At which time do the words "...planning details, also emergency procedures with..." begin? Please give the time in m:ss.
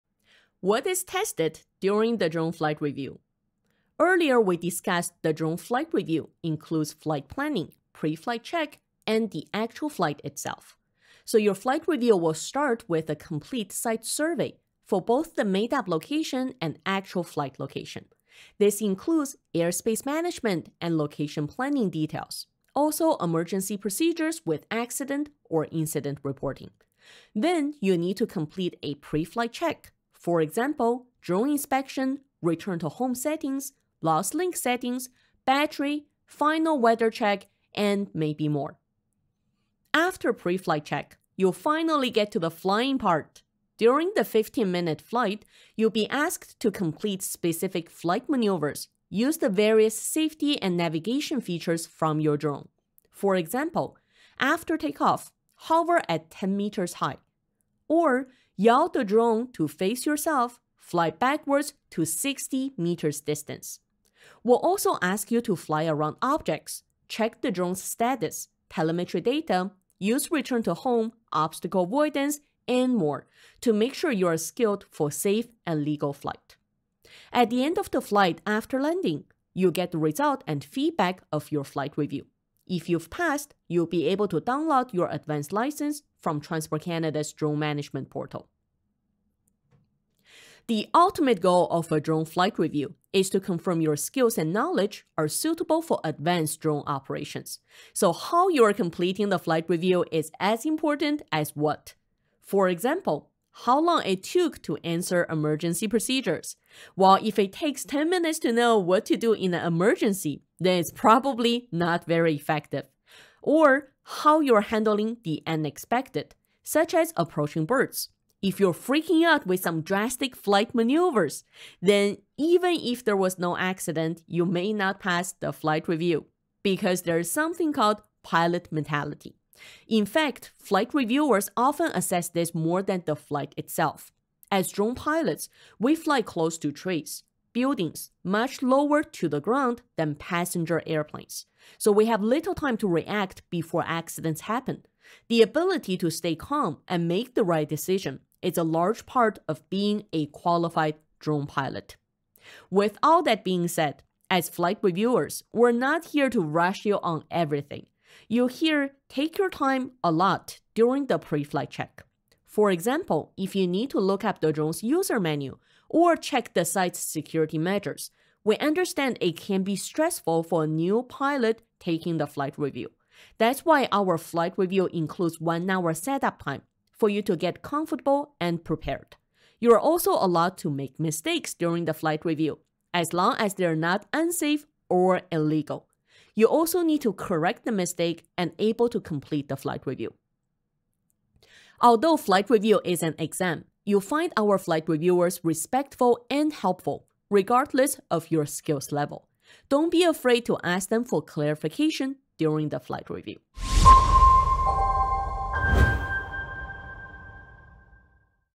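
0:21.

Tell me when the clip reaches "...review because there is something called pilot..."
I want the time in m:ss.
2:05.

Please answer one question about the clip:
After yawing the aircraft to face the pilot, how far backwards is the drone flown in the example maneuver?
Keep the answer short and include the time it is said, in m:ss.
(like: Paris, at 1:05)
60 meters, at 1:02.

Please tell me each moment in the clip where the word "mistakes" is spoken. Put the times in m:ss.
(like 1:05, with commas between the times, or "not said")
3:01, 3:07.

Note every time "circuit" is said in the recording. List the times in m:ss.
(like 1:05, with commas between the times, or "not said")
not said.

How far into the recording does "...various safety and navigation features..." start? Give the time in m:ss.
0:49.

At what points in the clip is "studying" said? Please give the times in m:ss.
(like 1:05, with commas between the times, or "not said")
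not said.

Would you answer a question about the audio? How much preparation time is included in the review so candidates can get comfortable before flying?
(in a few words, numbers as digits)
One hour.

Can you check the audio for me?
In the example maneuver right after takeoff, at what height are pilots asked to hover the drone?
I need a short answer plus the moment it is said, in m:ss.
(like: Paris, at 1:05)
10 meters, at 0:56.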